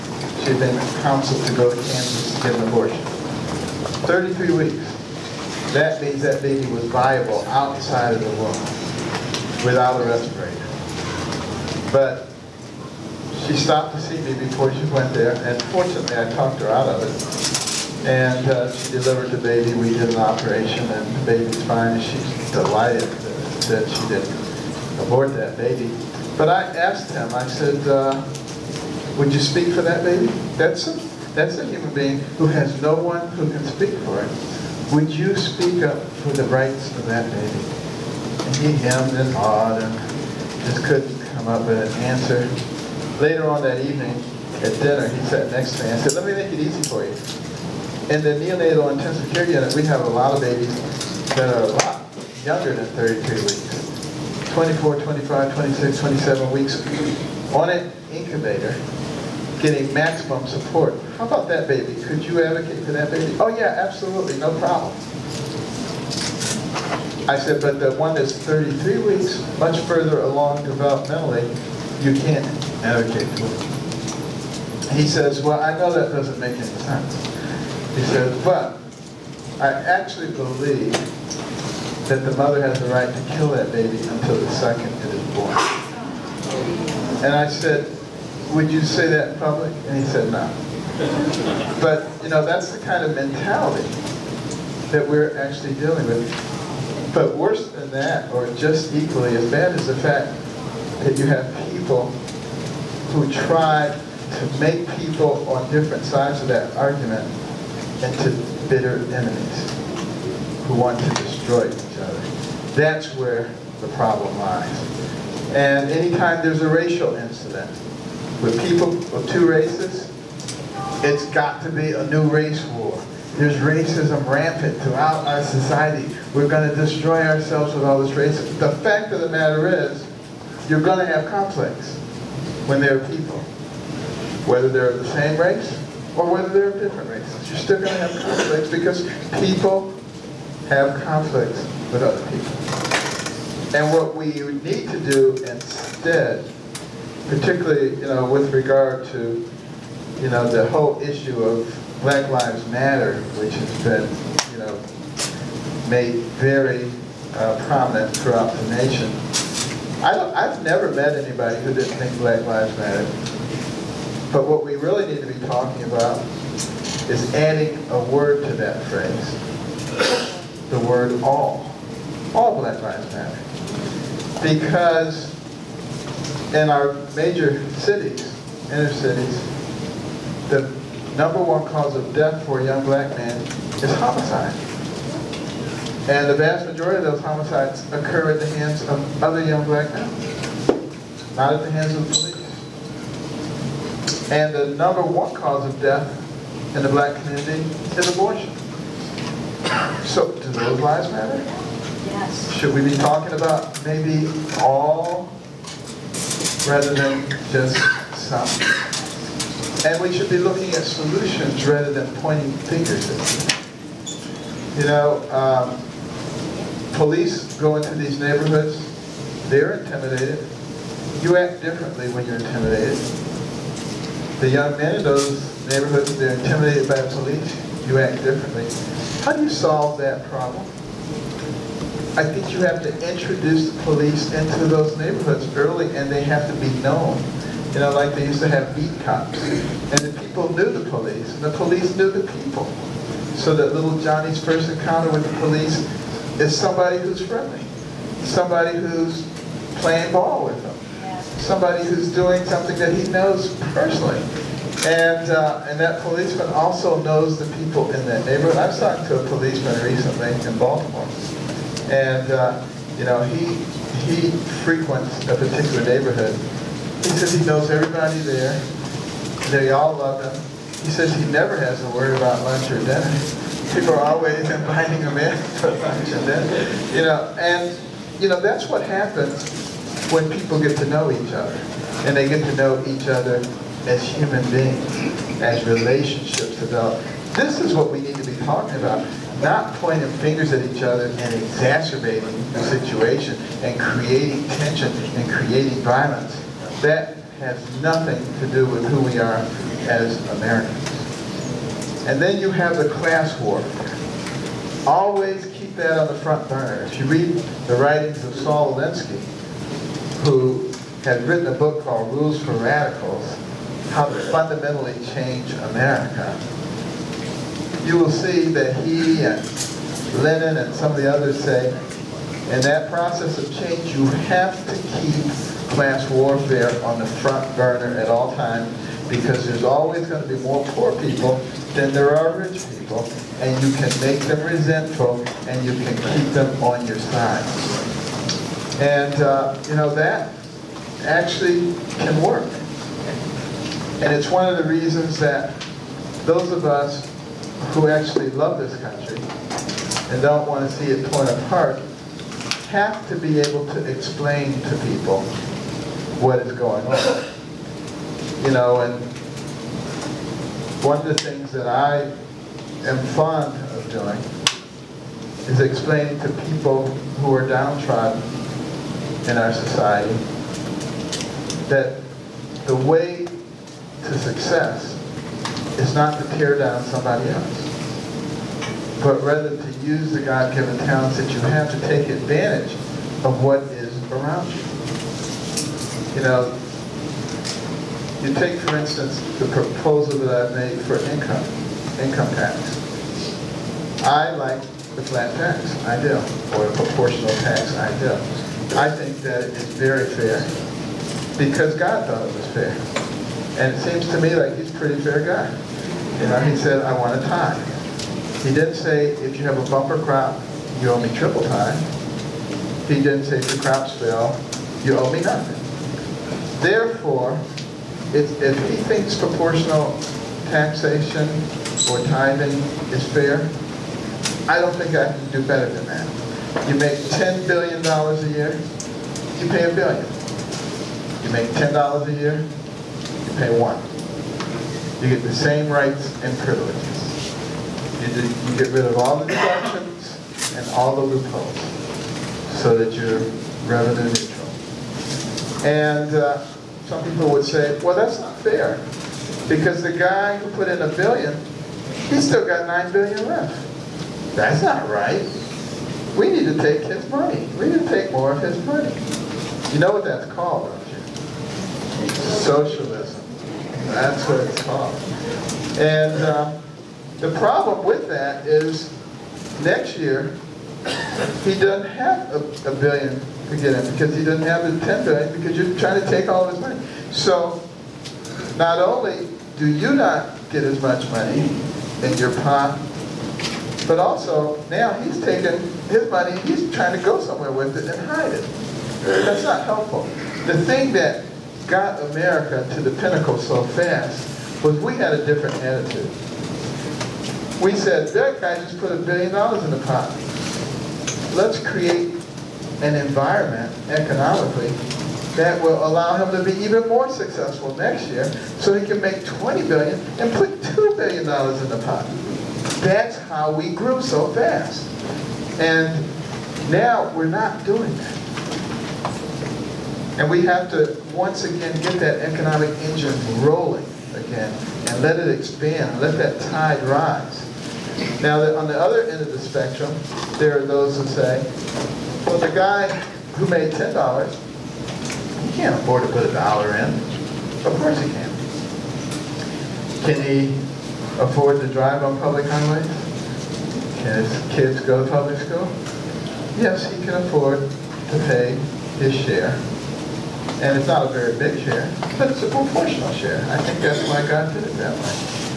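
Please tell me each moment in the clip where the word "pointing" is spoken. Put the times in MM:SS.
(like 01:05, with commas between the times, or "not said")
03:32, 04:49.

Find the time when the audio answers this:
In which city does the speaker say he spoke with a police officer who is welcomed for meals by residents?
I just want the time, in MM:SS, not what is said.
04:20.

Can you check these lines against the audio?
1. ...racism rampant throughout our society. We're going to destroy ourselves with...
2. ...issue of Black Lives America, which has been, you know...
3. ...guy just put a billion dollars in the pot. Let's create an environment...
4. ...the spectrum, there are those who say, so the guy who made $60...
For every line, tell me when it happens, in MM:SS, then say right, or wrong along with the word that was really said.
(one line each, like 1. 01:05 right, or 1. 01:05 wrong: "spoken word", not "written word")
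1. 02:03 right
2. 02:30 wrong: "Matter", not "America"
3. 08:18 right
4. 08:49 wrong: "10", not "60".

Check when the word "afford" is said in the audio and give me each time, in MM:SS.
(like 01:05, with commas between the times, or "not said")
08:55, 09:01, 09:07.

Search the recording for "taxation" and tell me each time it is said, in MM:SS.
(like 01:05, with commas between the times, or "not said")
07:00.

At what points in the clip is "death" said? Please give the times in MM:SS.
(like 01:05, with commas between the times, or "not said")
03:02, 03:15.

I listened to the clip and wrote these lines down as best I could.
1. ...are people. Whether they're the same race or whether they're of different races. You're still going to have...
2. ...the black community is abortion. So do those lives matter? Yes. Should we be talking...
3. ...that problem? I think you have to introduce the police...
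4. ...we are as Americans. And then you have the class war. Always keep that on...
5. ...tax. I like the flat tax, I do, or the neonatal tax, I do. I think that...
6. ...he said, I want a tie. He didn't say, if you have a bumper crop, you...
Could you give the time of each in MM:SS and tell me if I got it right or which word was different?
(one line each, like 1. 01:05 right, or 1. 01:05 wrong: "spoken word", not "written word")
1. 02:13 right
2. 03:16 right
3. 03:49 right
4. 04:59 right
5. 06:32 wrong: "proportional", not "neonatal"
6. 06:46 right.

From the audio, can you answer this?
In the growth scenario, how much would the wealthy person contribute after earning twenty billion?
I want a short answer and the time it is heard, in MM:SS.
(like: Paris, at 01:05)
$2 billion, at 08:30.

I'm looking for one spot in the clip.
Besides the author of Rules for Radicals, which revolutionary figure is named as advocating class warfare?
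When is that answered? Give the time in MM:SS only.
05:20.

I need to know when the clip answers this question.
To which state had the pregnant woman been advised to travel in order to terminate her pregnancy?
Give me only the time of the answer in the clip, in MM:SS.
00:01.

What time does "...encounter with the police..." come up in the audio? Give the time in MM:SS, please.
04:04.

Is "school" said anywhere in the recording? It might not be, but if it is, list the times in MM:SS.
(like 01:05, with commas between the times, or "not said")
09:05.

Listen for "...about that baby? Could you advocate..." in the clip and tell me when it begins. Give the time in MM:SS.
01:01.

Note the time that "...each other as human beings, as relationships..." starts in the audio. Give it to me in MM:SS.
04:42.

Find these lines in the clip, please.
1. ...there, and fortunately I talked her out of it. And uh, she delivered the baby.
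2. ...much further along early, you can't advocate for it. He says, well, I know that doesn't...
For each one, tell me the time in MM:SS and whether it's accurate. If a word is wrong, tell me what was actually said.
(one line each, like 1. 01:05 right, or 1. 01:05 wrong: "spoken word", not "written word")
1. 00:15 right
2. 01:09 wrong: "developmentally", not "early".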